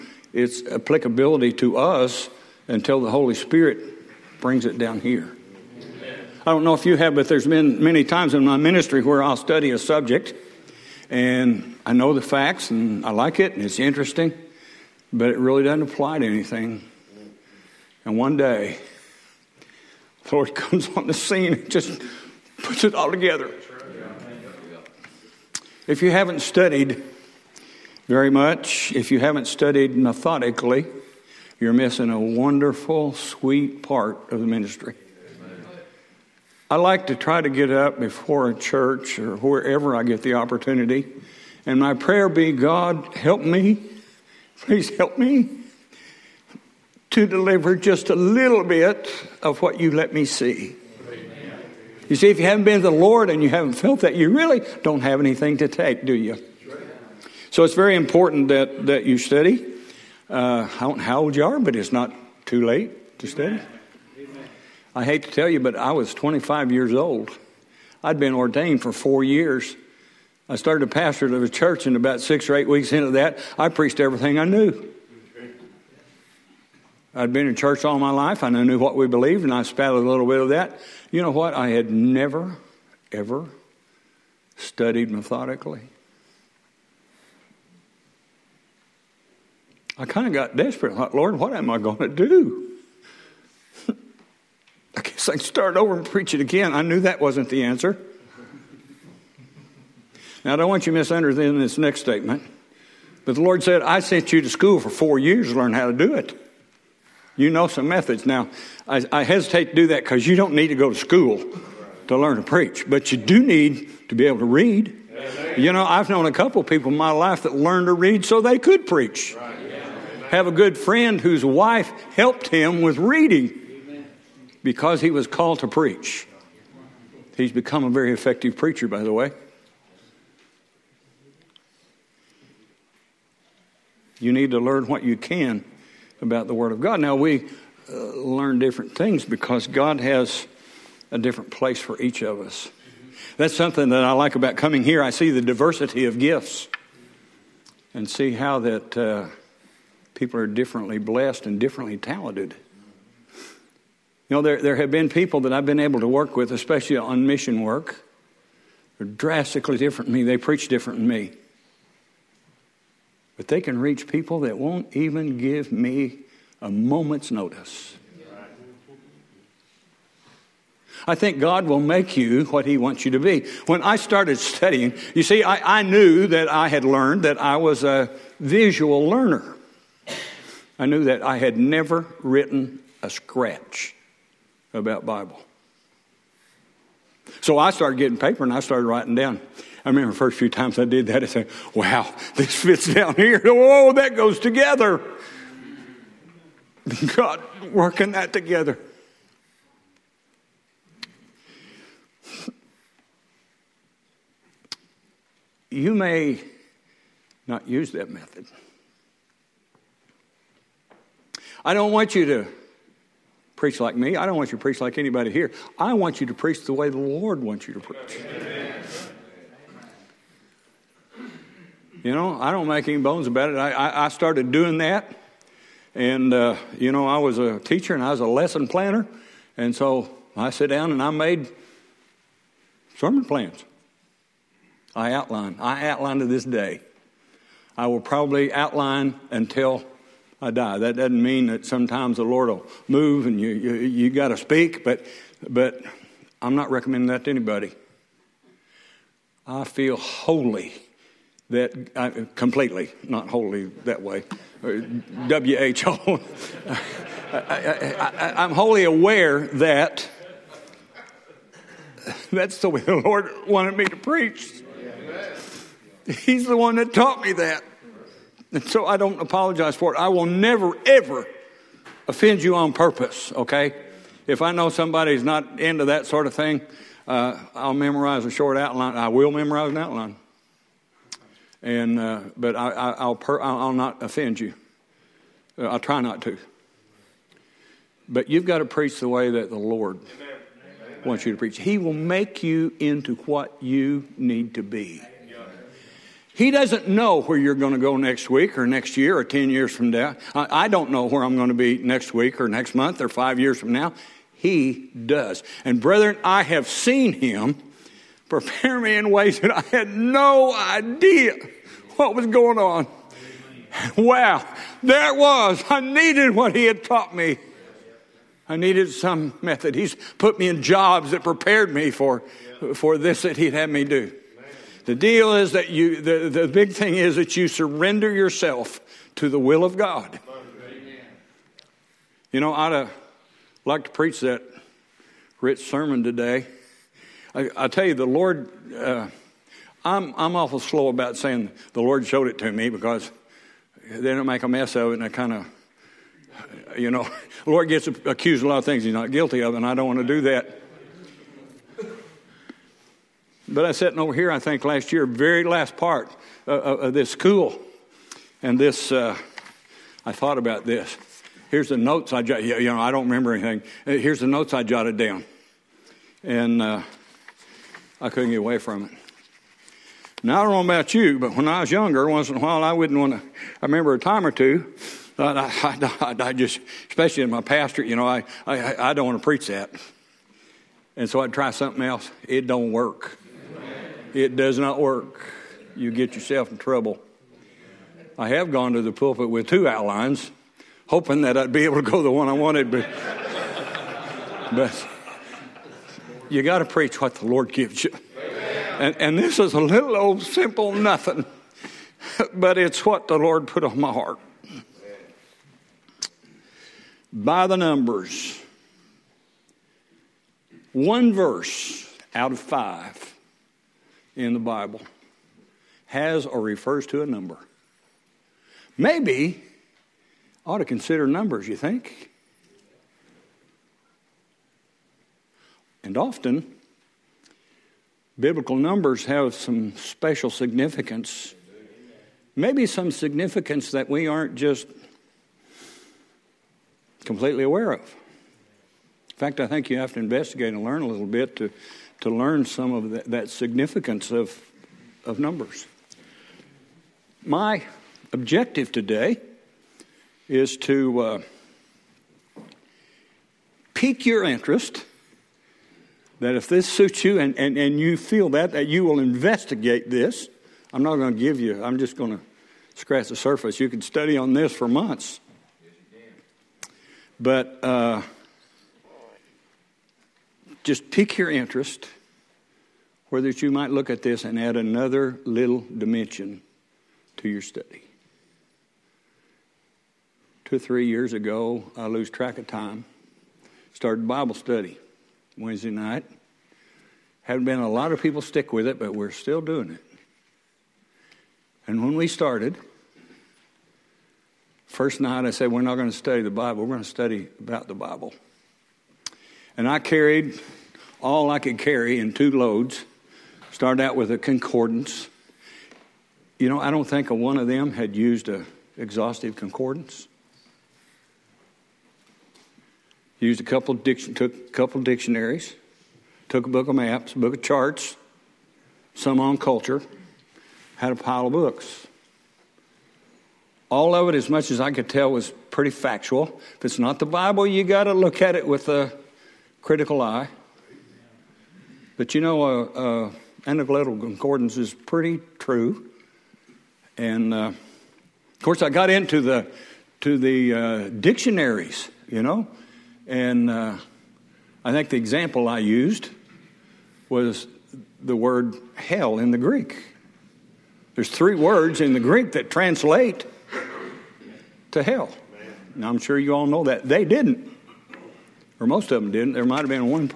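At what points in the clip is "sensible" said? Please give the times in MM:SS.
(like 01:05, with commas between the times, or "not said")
not said.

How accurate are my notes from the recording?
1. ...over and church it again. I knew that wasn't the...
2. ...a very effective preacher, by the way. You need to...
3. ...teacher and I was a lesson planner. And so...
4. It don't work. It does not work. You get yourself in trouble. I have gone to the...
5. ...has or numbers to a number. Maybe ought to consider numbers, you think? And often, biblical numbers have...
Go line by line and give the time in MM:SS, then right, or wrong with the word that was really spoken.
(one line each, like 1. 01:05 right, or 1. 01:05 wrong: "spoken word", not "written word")
1. 01:35 wrong: "preach", not "church"
2. 02:07 right
3. 03:47 right
4. 06:22 right
5. 06:55 wrong: "refers", not "numbers".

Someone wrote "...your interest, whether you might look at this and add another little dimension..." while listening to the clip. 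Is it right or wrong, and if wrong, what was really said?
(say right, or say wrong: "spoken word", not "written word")
right.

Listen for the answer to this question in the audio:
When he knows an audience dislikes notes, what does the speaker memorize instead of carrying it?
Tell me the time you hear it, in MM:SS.
04:38.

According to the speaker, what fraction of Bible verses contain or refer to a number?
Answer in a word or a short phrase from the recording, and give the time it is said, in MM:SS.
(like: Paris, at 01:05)
1 out of 5, at 06:50.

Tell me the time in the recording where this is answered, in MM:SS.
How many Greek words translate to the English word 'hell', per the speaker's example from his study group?
09:11.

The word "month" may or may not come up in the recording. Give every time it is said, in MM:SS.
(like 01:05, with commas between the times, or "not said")
05:02, 07:44.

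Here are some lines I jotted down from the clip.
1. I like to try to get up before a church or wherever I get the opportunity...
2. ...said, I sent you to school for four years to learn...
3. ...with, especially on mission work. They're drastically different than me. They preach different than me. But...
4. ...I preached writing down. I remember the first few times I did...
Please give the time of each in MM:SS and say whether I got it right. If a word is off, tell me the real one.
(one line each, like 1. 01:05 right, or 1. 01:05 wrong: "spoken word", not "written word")
1. 00:36 right
2. 01:43 right
3. 02:36 right
4. 03:08 wrong: "started", not "preached".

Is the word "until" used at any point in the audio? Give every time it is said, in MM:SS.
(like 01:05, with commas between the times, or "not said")
00:02, 03:59.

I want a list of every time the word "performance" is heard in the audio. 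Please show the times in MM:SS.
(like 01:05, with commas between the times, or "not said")
not said.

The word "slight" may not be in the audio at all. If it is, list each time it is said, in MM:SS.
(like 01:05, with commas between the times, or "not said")
not said.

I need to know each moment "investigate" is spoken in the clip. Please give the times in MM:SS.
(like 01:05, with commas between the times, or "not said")
07:19, 07:38.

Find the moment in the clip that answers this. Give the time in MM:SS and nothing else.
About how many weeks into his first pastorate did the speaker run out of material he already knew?
01:12.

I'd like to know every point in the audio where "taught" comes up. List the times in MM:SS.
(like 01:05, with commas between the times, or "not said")
04:26, 05:16.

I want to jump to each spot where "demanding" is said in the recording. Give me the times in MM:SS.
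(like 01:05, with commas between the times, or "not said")
not said.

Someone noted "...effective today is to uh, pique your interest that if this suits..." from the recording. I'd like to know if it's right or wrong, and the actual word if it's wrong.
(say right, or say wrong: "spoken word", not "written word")
wrong: "objective", not "effective".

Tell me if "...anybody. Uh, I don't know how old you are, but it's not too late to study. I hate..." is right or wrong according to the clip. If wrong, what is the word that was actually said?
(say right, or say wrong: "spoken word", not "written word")
wrong: "study", not "anybody".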